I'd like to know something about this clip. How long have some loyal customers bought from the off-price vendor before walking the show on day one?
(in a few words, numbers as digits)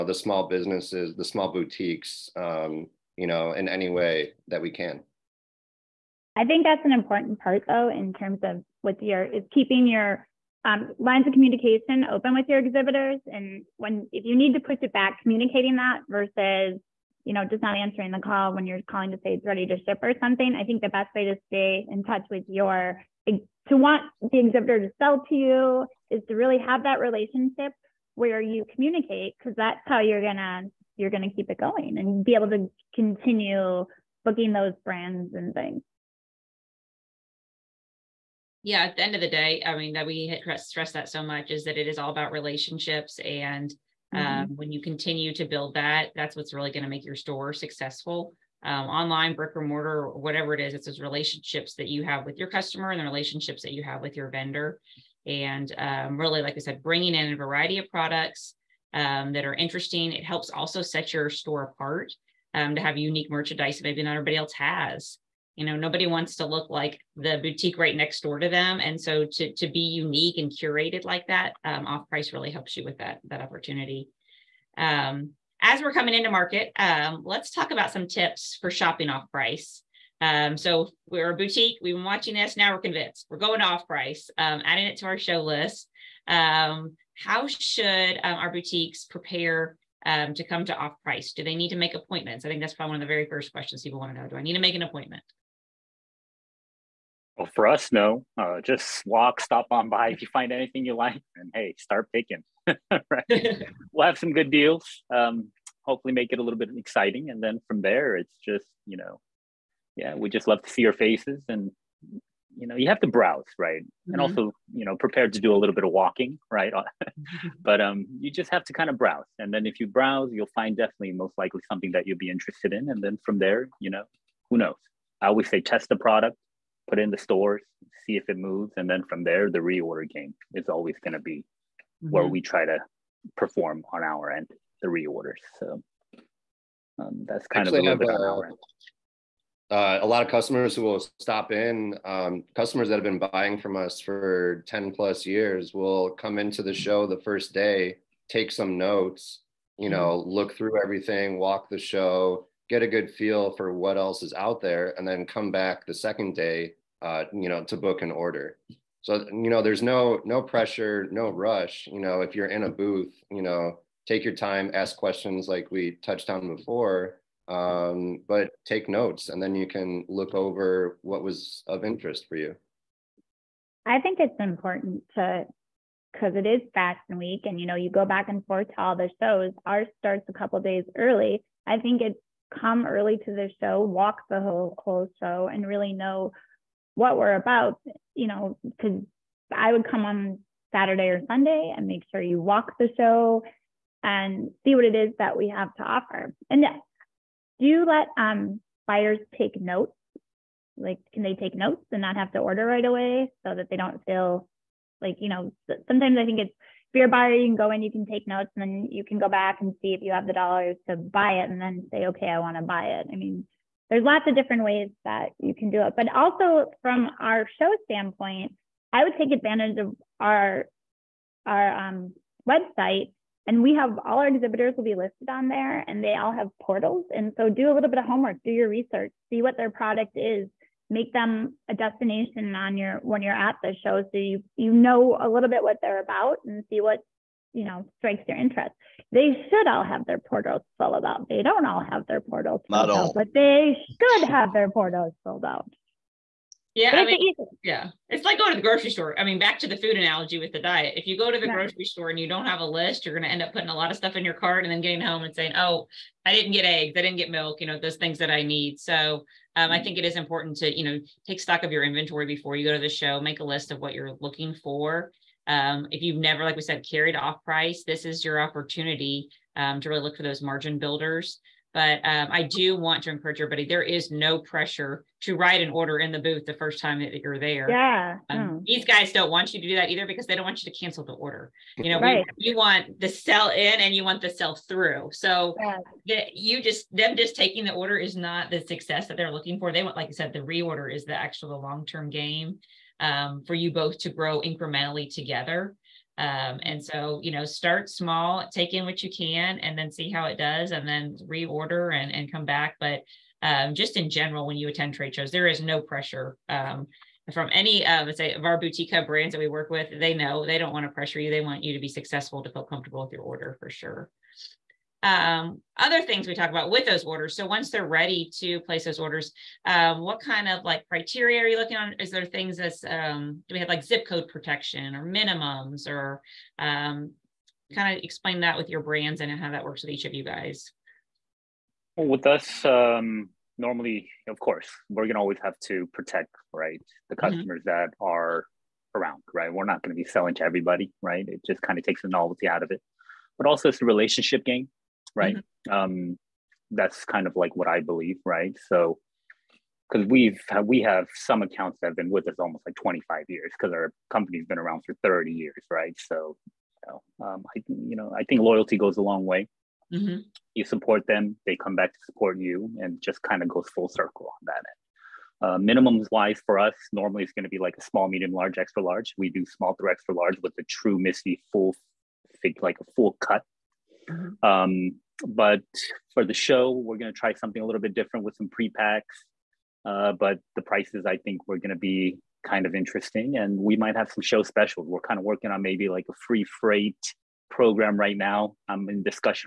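10 plus years.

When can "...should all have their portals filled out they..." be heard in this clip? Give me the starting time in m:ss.
3:59.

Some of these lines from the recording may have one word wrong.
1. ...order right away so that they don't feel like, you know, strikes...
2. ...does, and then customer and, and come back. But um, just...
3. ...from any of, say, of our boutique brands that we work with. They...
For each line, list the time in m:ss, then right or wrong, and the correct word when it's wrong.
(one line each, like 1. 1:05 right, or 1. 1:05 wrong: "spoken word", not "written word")
1. 3:22 wrong: "sometimes", not "strikes"
2. 5:00 wrong: "reorder", not "customer"
3. 5:07 right.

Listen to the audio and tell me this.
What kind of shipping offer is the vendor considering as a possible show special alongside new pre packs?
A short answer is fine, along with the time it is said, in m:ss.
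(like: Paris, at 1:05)
free freight program, at 6:26.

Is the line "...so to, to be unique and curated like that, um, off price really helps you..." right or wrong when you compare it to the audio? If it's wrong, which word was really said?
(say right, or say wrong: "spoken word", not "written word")
right.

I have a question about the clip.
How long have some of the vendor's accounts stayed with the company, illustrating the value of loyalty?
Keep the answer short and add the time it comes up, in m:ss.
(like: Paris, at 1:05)
almost 25 years, at 5:52.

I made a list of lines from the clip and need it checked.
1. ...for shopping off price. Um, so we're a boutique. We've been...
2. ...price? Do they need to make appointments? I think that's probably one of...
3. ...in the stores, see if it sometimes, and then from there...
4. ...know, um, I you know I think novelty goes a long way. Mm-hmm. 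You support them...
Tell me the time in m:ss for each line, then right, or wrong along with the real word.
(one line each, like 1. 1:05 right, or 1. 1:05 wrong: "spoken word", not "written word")
1. 1:18 right
2. 1:31 right
3. 2:06 wrong: "moves", not "sometimes"
4. 5:57 wrong: "loyalty", not "novelty".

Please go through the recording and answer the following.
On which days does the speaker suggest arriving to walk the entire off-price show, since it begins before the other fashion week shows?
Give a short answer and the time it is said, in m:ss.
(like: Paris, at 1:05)
Saturday or Sunday, at 3:10.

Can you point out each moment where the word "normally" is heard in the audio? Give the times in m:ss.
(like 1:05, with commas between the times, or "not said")
5:33, 6:06.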